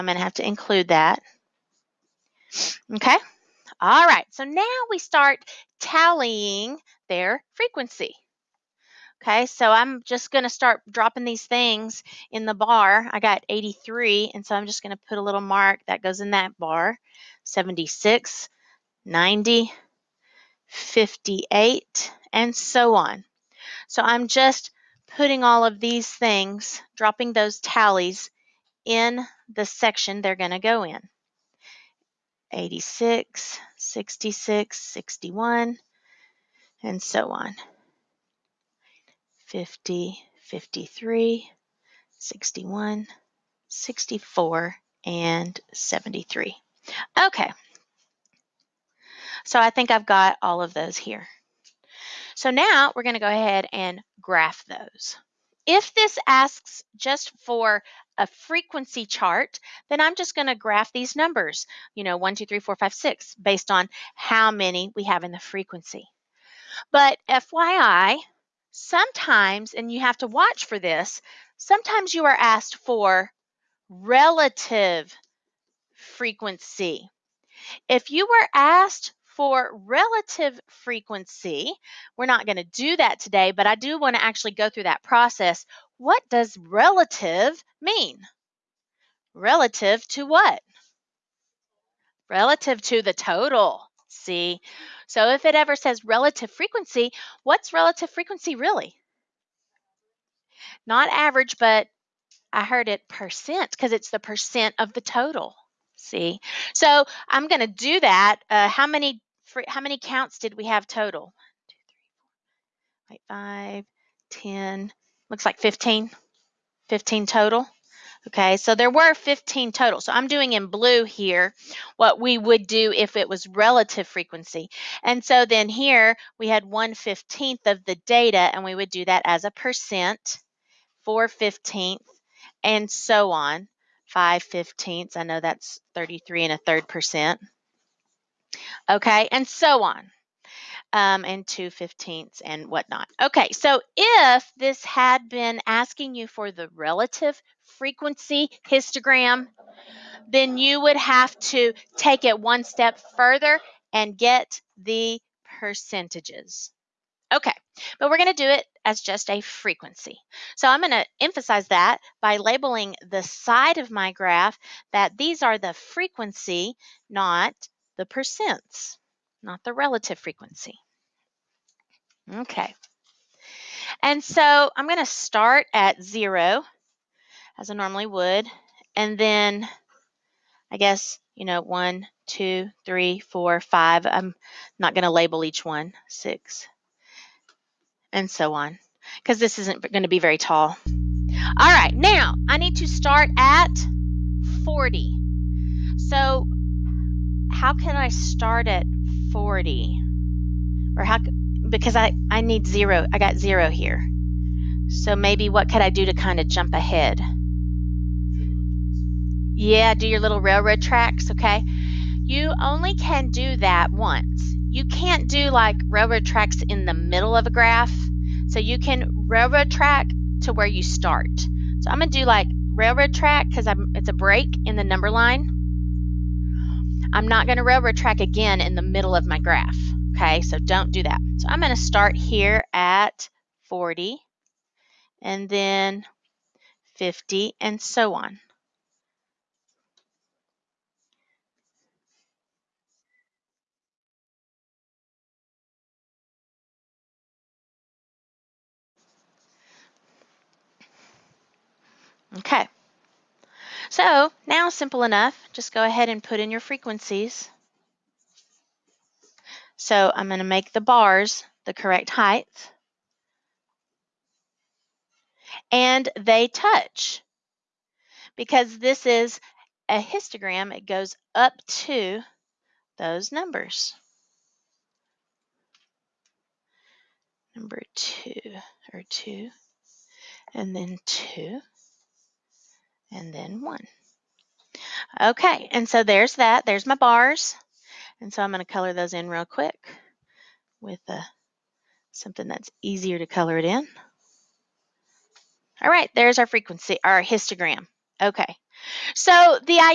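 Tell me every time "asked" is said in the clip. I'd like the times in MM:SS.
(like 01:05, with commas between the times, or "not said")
01:12, 01:18.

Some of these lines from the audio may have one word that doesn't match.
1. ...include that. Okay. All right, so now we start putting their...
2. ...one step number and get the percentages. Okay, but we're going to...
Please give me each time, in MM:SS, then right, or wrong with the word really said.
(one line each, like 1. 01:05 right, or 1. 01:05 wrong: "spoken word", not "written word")
1. 00:00 wrong: "tallying", not "putting"
2. 02:32 wrong: "further", not "number".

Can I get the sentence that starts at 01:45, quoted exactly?
See, so I'm going to do that.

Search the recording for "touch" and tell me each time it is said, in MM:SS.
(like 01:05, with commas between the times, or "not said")
04:26.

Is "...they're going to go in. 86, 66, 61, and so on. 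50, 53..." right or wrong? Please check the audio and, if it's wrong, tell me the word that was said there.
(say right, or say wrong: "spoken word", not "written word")
right.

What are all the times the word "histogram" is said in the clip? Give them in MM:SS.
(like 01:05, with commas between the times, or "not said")
02:28, 04:30, 04:57.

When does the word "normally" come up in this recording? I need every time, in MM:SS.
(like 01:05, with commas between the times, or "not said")
02:57.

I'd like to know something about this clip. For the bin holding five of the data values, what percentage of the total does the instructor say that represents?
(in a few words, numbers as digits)
33 and a third percent.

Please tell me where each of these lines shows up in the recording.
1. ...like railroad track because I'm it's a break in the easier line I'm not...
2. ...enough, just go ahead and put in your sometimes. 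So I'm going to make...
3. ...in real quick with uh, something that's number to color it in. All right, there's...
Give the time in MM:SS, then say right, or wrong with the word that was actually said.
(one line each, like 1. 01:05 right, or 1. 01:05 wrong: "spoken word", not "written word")
1. 03:42 wrong: "number", not "easier"
2. 04:15 wrong: "frequencies", not "sometimes"
3. 04:49 wrong: "easier", not "number".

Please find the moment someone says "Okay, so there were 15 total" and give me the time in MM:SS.
01:58.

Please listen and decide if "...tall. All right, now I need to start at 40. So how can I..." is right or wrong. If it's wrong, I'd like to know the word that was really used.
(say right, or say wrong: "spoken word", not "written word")
right.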